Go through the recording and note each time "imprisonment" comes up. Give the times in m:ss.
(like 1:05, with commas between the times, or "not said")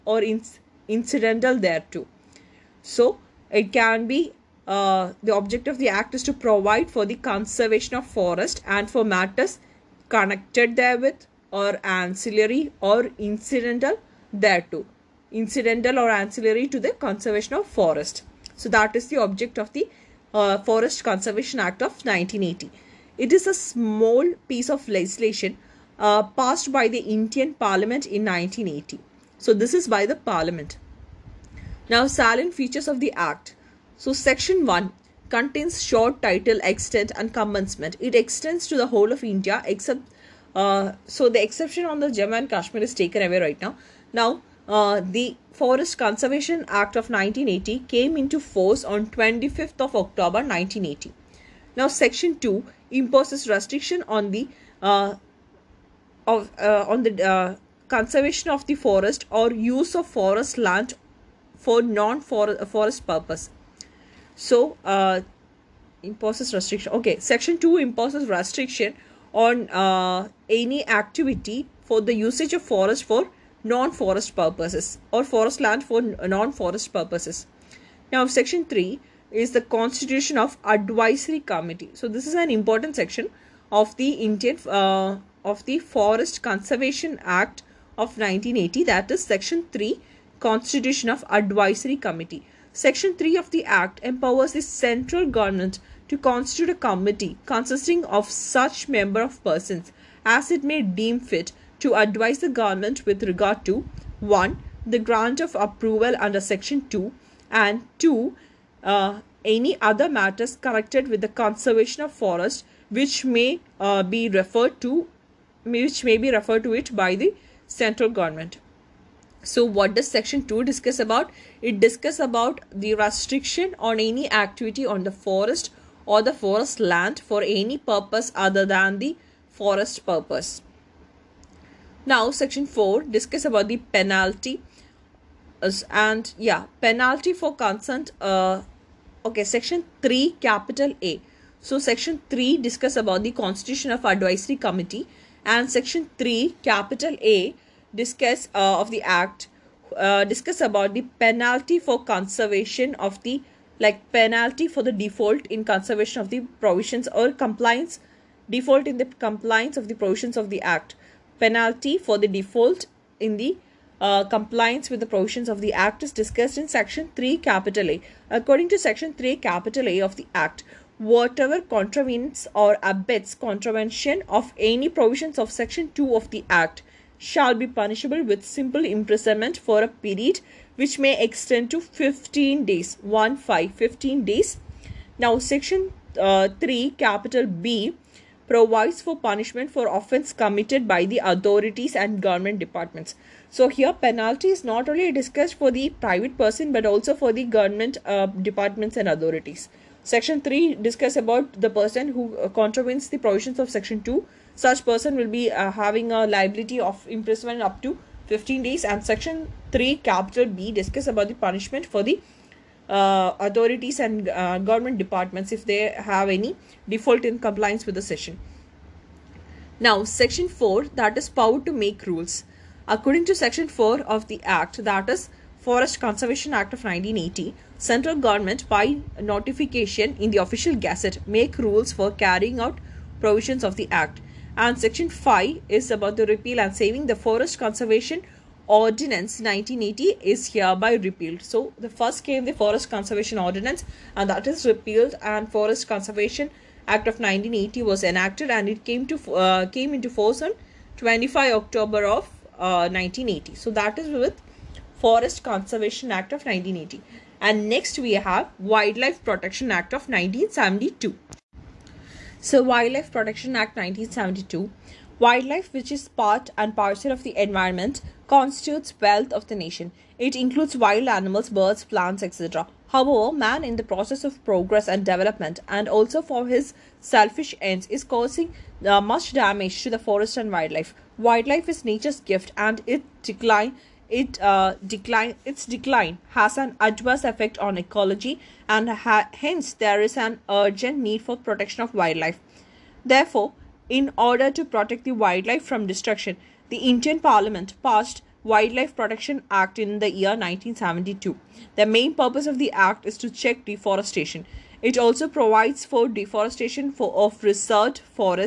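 2:58, 3:27.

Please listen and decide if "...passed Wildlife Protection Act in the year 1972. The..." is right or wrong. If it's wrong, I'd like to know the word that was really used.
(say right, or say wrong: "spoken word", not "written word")
right.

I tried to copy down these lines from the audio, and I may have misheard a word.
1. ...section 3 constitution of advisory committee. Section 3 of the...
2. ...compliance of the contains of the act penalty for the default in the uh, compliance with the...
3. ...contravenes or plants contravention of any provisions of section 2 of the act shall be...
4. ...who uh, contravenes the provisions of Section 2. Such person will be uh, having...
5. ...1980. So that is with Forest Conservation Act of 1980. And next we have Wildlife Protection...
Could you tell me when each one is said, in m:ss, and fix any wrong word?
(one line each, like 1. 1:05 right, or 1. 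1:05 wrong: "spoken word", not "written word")
1. 1:29 right
2. 2:39 wrong: "provisions", not "contains"
3. 2:51 wrong: "abets", not "plants"
4. 3:22 right
5. 4:12 right.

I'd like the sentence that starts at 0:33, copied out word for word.
So Section 1 contains short title, extent and commencement.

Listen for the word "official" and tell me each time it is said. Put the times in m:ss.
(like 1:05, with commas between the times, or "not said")
3:50.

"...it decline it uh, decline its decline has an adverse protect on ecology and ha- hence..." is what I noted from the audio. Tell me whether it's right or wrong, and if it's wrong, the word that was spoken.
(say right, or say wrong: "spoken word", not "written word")
wrong: "effect", not "protect".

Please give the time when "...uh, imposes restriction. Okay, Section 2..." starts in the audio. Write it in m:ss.
1:04.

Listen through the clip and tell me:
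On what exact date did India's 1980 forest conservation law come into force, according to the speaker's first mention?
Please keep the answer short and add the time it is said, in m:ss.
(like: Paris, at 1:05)
25th of October 1980, at 0:49.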